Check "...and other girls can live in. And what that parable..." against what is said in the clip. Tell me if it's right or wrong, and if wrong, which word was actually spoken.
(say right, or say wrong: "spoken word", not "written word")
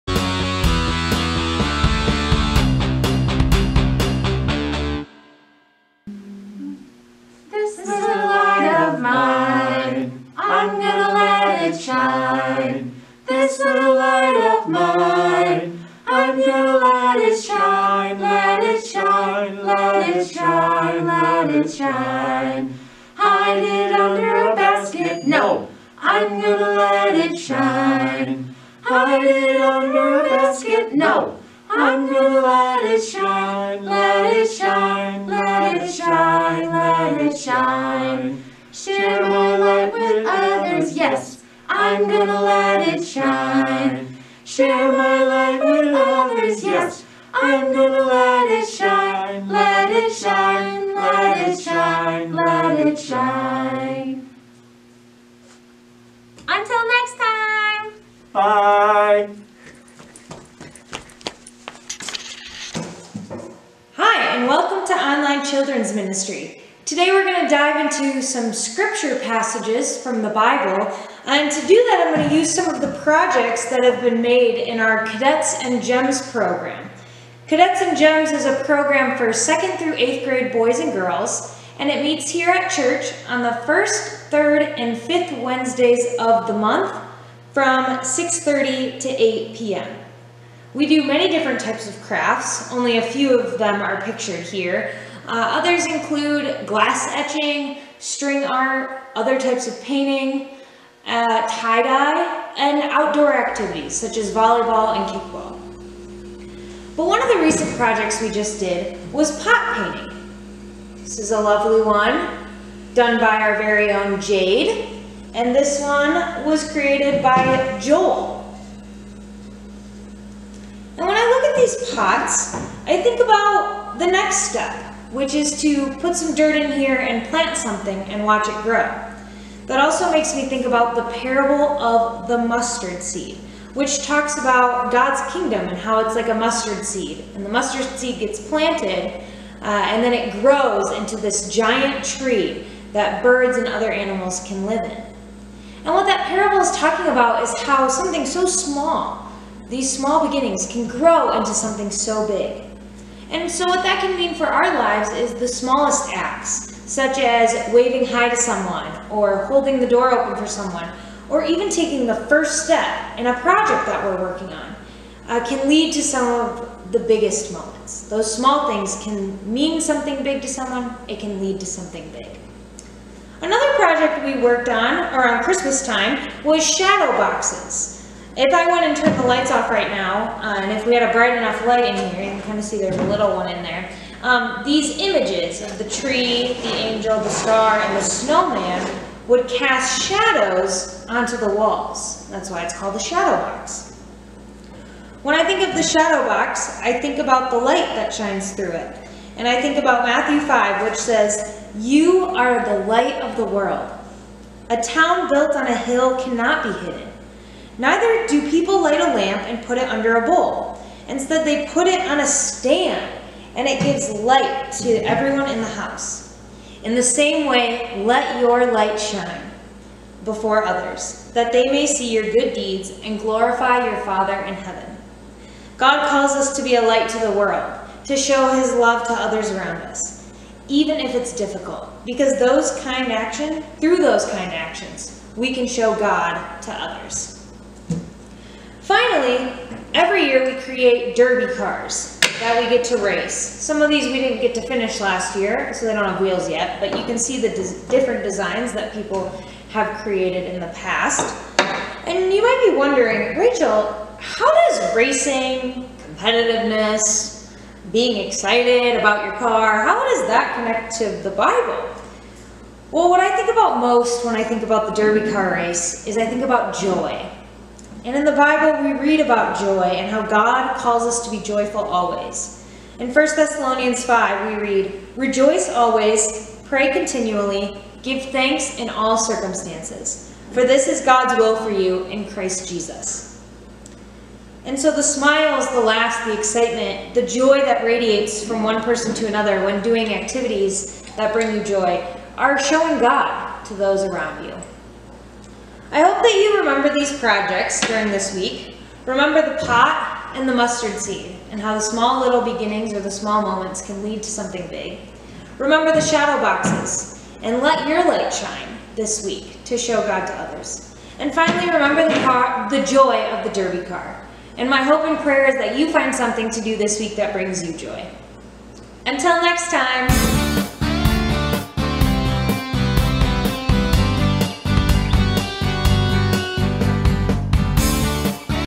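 wrong: "animals", not "girls".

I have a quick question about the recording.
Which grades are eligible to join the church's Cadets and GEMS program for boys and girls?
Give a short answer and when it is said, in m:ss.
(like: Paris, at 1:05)
2nd through 8th grade, at 1:19.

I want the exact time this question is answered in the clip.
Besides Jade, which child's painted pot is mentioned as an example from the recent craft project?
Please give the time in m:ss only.
1:57.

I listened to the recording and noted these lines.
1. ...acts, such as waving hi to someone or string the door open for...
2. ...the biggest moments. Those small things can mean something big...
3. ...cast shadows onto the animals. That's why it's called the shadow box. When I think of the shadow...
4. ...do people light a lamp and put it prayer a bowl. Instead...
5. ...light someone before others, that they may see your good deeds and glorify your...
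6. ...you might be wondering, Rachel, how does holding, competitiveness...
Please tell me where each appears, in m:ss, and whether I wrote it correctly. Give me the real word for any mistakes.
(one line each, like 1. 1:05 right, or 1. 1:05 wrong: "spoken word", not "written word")
1. 2:36 wrong: "holding", not "string"
2. 2:46 right
3. 3:09 wrong: "walls", not "animals"
4. 3:28 wrong: "under", not "prayer"
5. 3:38 wrong: "shine", not "someone"
6. 4:12 wrong: "racing", not "holding".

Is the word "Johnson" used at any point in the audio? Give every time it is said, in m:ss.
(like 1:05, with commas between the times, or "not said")
not said.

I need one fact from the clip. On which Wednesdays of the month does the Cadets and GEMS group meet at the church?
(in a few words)
First, third, and fifth.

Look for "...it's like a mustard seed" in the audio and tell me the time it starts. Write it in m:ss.
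2:16.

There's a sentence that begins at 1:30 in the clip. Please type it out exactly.
We do many different types of crafts, only a few of them are pictured here.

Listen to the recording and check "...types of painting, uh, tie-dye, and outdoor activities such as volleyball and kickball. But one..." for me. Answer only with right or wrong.
right.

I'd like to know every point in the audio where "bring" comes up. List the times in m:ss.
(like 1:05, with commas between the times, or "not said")
4:51, 5:17.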